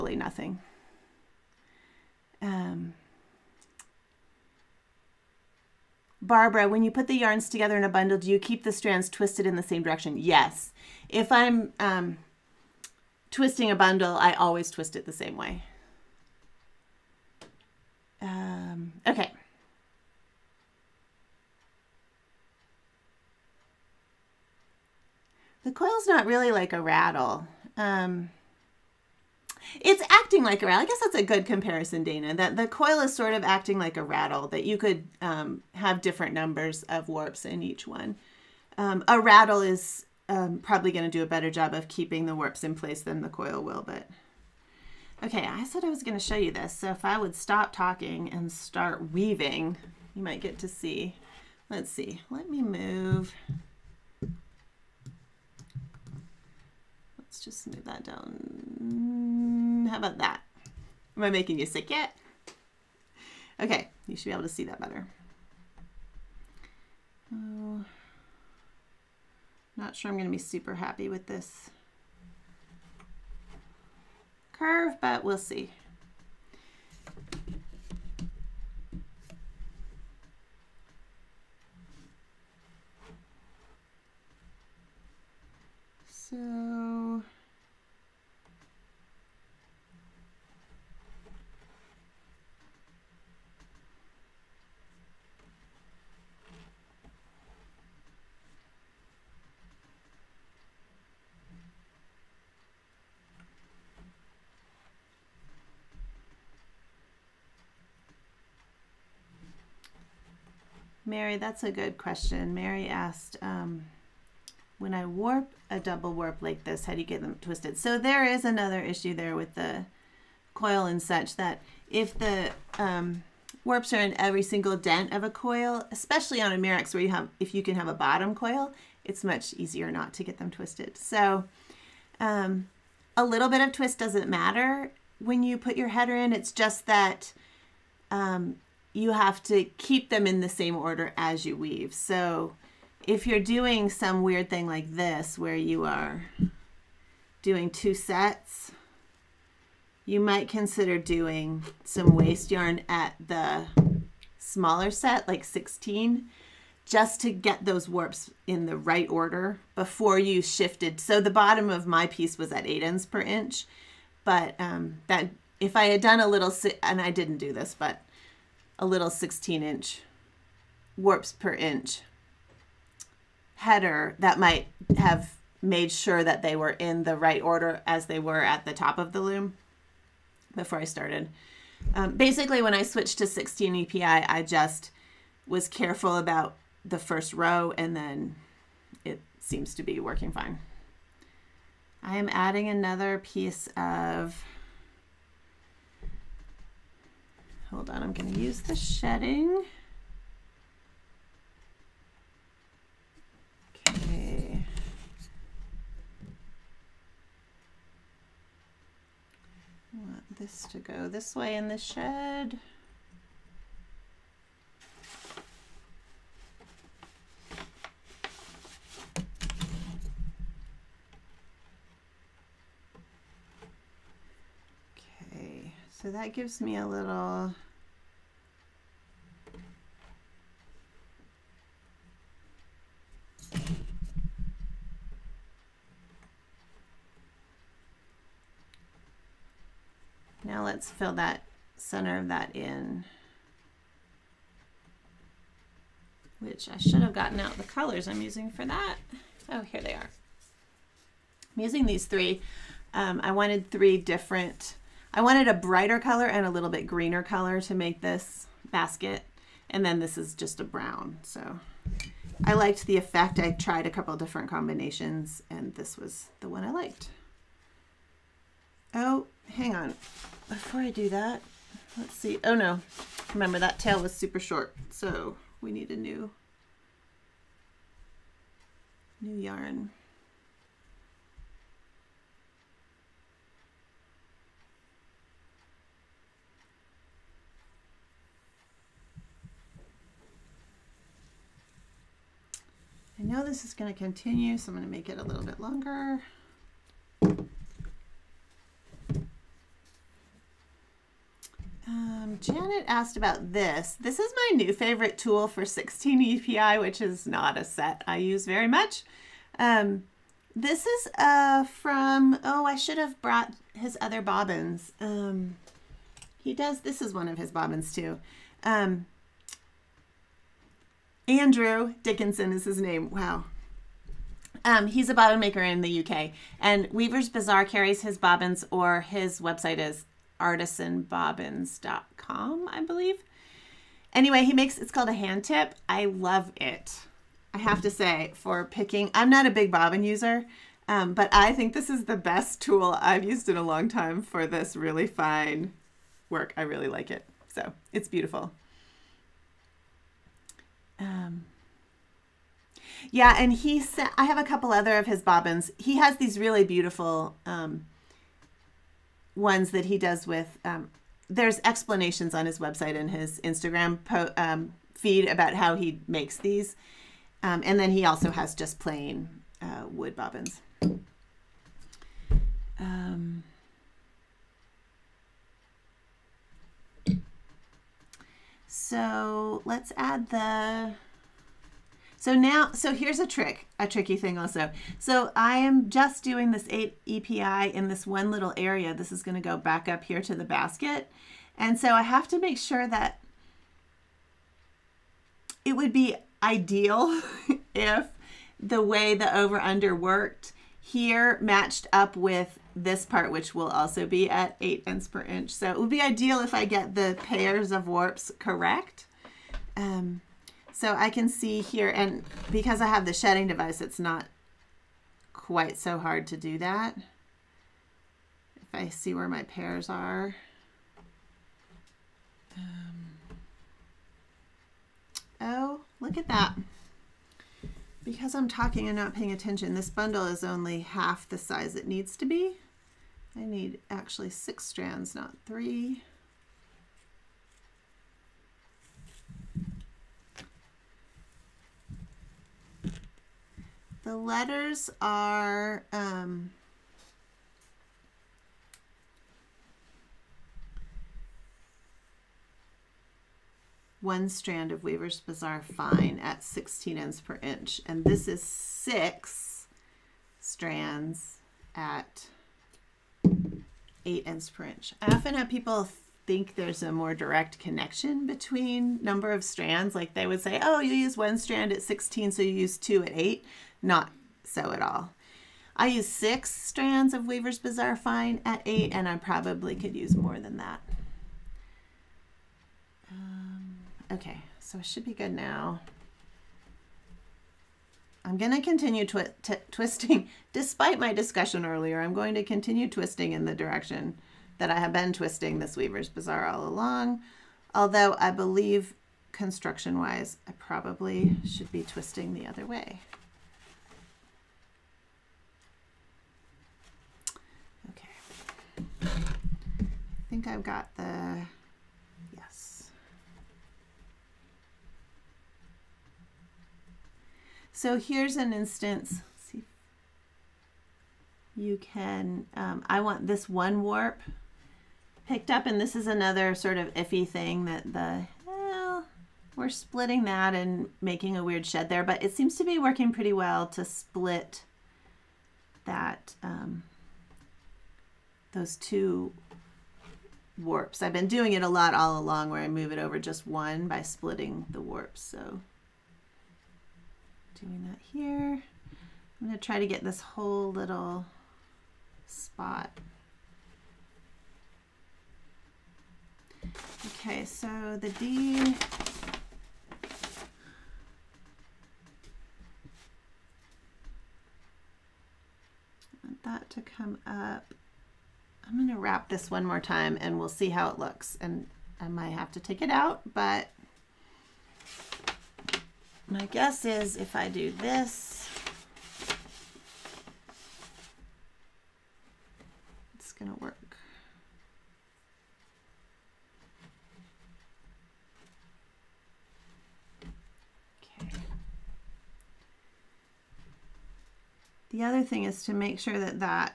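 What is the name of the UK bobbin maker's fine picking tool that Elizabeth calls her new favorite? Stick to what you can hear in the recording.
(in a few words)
hand tip.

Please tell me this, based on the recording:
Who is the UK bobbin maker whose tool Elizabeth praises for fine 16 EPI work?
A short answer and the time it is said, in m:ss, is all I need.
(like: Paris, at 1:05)
Andrew Dickinson, at 5:21.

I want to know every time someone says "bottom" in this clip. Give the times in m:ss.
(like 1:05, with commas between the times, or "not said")
2:07, 2:41.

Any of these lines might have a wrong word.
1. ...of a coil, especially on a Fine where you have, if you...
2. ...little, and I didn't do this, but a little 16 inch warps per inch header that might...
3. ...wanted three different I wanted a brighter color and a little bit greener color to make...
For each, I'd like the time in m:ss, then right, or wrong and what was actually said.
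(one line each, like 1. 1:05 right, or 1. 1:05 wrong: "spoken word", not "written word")
1. 2:05 wrong: "Mirrix", not "Fine"
2. 2:46 right
3. 4:13 right.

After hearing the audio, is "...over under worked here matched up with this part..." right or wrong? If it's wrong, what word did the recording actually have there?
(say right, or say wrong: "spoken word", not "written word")
right.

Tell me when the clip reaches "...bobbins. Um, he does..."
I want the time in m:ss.
5:14.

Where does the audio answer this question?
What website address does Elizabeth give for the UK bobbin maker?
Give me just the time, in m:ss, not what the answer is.
5:30.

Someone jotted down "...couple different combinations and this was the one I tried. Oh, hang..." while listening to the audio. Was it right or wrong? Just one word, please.
wrong.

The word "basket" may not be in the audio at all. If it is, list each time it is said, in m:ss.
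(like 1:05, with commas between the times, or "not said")
4:18, 6:30.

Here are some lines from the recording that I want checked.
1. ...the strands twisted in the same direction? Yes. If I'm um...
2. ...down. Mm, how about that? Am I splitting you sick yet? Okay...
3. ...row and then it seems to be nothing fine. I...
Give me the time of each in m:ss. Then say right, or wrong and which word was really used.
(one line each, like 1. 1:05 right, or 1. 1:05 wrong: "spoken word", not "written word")
1. 0:08 right
2. 0:58 wrong: "making", not "splitting"
3. 3:07 wrong: "working", not "nothing".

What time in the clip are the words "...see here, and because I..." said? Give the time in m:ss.
6:51.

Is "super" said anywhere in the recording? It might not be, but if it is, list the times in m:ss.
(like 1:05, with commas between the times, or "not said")
1:10, 4:34.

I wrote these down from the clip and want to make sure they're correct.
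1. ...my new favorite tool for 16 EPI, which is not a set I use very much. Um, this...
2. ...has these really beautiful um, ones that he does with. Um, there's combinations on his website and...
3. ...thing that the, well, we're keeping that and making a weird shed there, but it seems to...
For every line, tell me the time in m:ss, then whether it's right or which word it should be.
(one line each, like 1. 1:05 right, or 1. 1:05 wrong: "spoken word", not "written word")
1. 5:04 right
2. 5:55 wrong: "explanations", not "combinations"
3. 8:47 wrong: "splitting", not "keeping".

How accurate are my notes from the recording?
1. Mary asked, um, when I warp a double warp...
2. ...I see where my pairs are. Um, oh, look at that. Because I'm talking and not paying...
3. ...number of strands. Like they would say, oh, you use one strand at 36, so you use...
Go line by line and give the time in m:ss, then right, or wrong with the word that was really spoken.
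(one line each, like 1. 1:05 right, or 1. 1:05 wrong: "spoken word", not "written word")
1. 1:52 right
2. 6:58 right
3. 7:49 wrong: "16", not "36".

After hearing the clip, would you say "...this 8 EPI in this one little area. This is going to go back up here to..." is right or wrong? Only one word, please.
right.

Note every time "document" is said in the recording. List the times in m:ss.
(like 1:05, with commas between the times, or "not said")
not said.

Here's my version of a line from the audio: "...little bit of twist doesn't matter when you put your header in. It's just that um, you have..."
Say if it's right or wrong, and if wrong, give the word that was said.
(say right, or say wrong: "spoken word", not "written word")
right.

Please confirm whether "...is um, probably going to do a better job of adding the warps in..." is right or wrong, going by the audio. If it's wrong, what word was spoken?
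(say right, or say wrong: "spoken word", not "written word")
wrong: "keeping", not "adding".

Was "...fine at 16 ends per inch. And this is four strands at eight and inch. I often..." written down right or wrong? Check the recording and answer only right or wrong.
wrong.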